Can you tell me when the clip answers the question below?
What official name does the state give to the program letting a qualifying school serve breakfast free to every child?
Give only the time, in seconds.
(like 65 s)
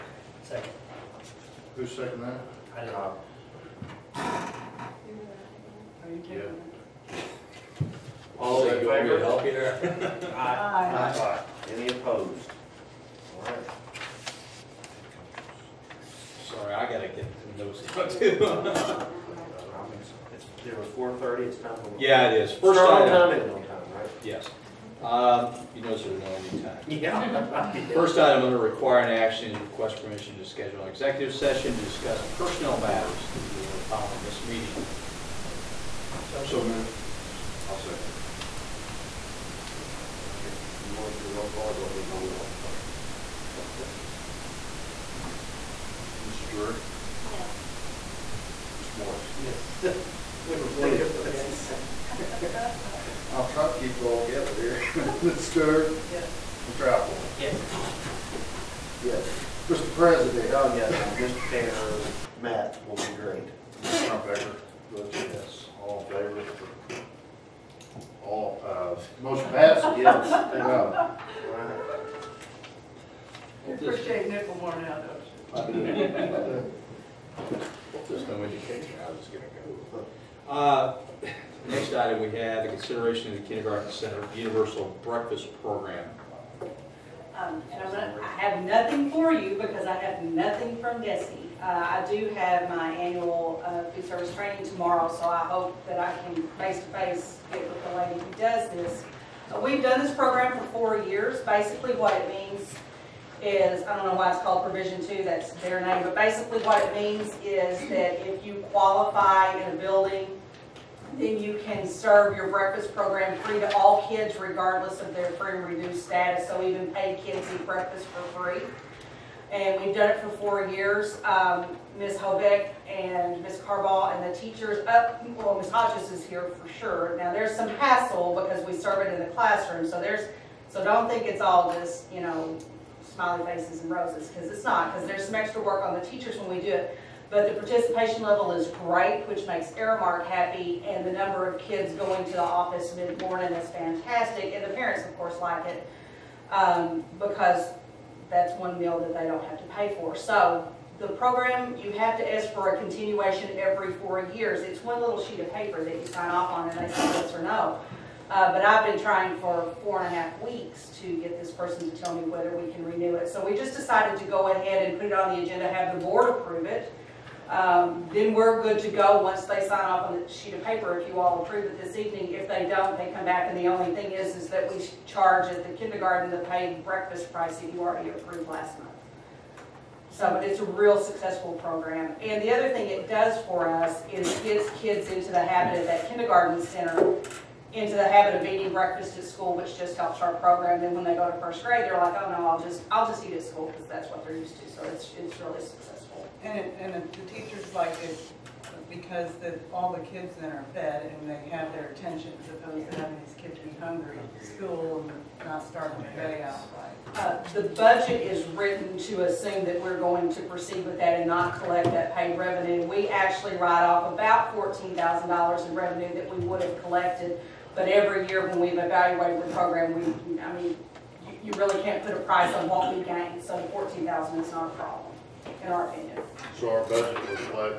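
104 s.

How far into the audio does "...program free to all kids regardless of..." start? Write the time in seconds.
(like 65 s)
112 s.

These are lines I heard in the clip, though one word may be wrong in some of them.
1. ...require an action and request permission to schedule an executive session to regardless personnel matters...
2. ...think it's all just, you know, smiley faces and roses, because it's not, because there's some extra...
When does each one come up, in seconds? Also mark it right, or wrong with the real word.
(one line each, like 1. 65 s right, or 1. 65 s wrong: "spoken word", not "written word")
1. 28 s wrong: "discuss", not "regardless"
2. 131 s right.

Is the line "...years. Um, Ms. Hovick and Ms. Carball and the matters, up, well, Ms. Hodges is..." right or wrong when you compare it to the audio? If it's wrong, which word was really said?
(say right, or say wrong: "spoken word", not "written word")
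wrong: "teachers", not "matters".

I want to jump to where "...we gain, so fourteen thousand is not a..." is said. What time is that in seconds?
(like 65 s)
222 s.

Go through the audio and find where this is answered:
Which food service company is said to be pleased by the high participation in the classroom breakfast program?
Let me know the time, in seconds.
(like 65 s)
139 s.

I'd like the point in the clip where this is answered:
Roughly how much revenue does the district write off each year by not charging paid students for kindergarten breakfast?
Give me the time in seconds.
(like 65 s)
214 s.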